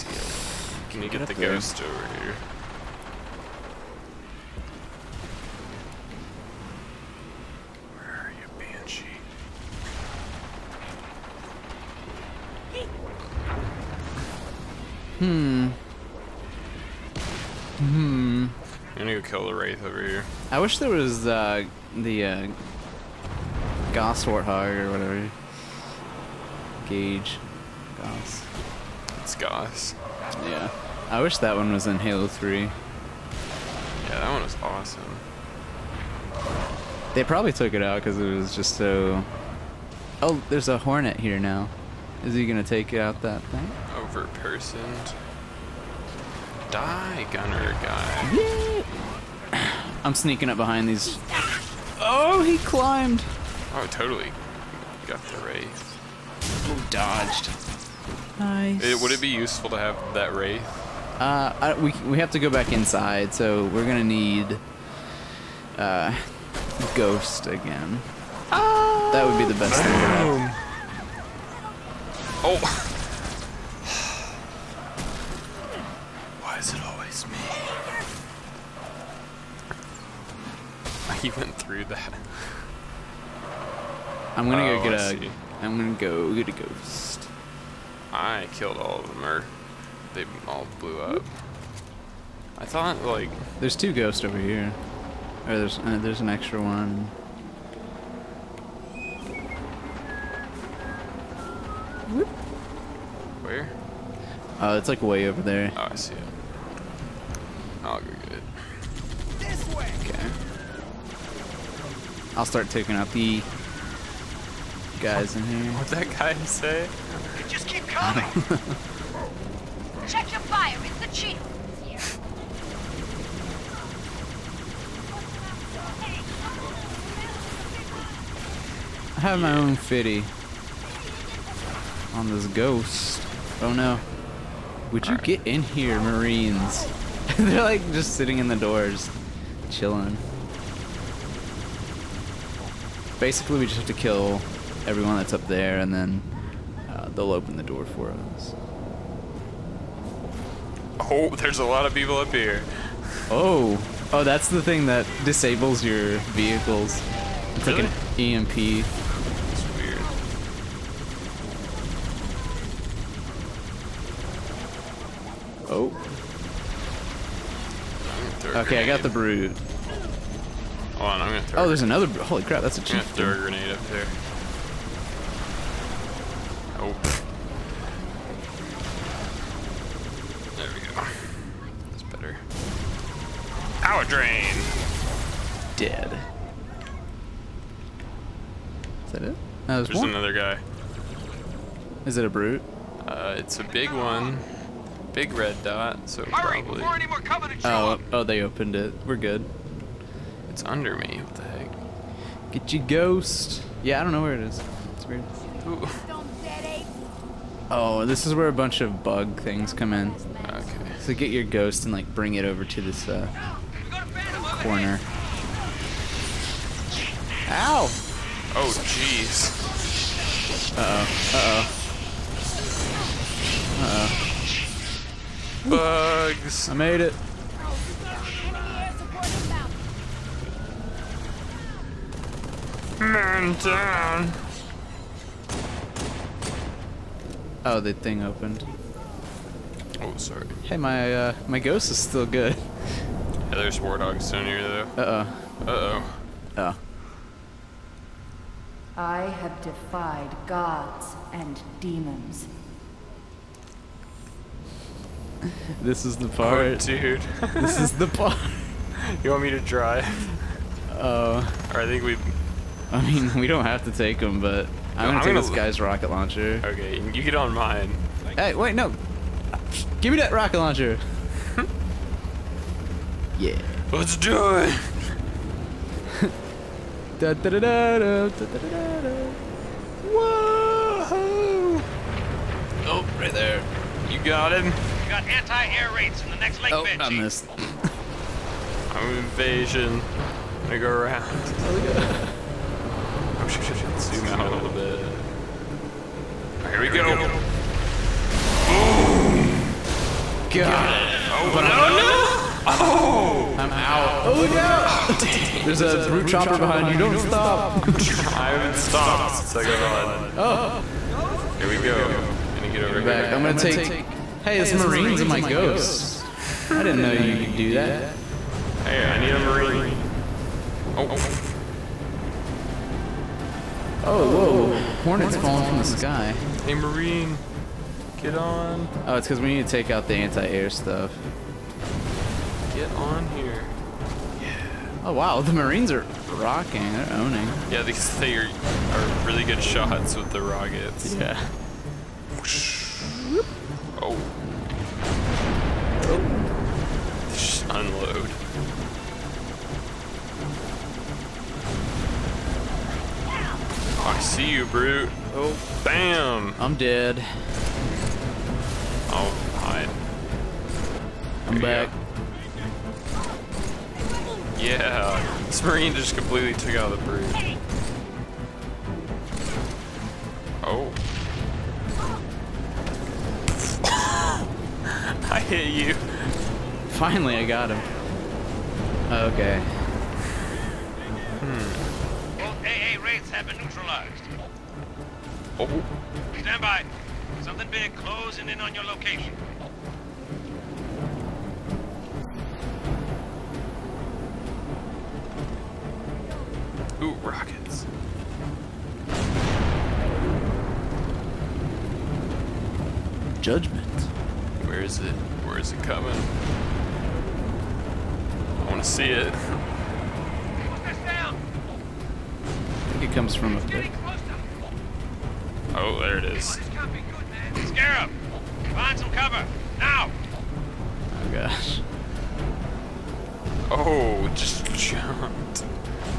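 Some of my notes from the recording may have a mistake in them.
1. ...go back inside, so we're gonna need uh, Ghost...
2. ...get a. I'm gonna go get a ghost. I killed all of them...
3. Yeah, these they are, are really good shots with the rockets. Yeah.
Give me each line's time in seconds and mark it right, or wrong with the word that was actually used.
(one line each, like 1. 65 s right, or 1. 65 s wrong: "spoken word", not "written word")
1. 62 s right
2. 84 s right
3. 337 s right.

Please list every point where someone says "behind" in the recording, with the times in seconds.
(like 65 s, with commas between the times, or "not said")
50 s, 306 s.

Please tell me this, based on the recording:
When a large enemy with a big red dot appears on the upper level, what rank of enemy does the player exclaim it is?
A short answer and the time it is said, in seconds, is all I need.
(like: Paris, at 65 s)
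a chief, at 172 s.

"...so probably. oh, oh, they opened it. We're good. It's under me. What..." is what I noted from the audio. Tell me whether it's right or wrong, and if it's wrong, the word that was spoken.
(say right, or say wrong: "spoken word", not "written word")
right.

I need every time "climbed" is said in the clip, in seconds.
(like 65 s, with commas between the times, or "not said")
52 s.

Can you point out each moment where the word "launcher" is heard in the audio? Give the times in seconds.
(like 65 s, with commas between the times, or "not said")
266 s, 270 s.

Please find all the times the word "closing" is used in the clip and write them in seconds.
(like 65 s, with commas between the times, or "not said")
387 s.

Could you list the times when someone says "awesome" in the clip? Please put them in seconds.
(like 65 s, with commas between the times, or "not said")
34 s.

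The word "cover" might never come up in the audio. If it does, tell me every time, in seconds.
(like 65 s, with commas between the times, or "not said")
419 s.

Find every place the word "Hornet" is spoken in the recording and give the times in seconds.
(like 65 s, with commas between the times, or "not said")
40 s, 325 s.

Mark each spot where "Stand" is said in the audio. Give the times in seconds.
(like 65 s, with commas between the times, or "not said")
386 s.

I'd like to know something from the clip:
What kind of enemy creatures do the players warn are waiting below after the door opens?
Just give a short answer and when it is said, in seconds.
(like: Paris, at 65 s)
war dogs, at 243 s.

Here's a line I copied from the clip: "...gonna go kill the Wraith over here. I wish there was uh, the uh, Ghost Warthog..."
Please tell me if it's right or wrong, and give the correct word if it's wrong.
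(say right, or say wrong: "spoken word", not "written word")
wrong: "Gauss", not "Ghost".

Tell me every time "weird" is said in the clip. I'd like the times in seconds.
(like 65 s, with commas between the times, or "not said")
159 s, 205 s.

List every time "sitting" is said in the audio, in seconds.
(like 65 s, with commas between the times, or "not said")
138 s.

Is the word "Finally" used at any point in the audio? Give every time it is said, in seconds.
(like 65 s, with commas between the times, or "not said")
376 s.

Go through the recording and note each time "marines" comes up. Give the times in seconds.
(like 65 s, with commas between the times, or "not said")
135 s, 314 s, 319 s, 326 s, 335 s, 365 s.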